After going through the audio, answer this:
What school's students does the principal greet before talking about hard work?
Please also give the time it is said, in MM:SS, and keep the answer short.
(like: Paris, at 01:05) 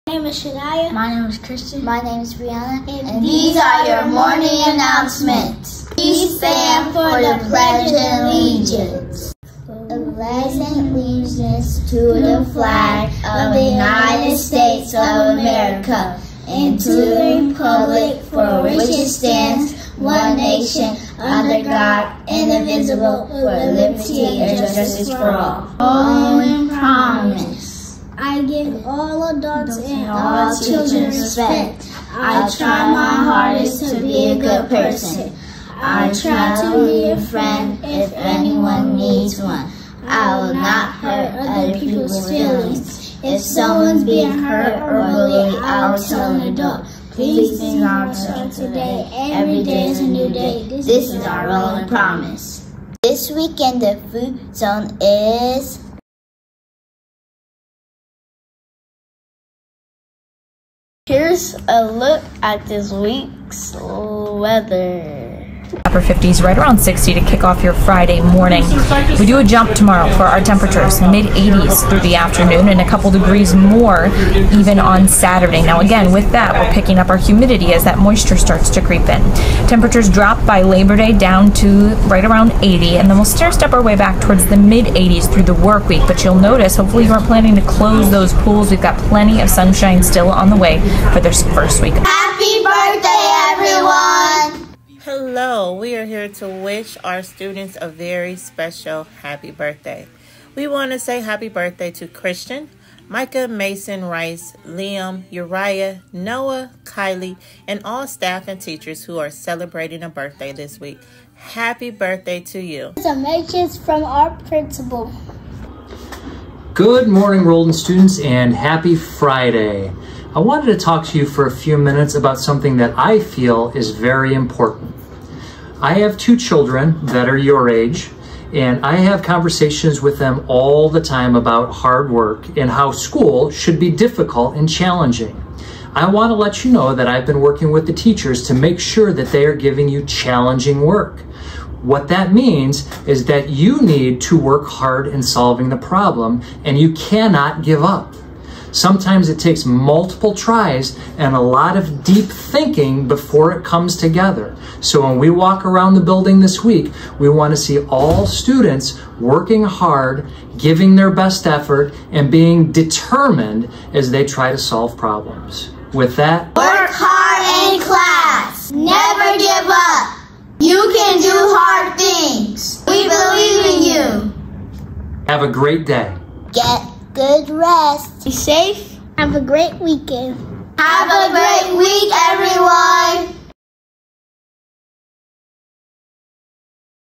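Rolden, at 01:57.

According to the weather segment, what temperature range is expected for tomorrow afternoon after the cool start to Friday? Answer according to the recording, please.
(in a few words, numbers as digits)
mid 80s.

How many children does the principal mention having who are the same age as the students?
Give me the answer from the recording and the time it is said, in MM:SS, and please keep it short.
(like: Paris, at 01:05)
2, at 02:06.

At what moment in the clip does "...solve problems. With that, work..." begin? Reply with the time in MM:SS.
02:44.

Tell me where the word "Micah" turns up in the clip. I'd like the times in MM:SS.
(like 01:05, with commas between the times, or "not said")
01:43.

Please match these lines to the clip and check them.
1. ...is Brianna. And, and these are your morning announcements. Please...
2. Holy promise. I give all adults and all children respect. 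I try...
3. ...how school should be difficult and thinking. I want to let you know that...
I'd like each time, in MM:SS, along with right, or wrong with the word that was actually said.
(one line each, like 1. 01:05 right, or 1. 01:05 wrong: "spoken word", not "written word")
1. 00:02 right
2. 00:25 right
3. 02:12 wrong: "challenging", not "thinking".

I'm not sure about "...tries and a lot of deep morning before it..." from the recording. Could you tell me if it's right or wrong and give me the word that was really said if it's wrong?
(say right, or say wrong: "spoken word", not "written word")
wrong: "thinking", not "morning".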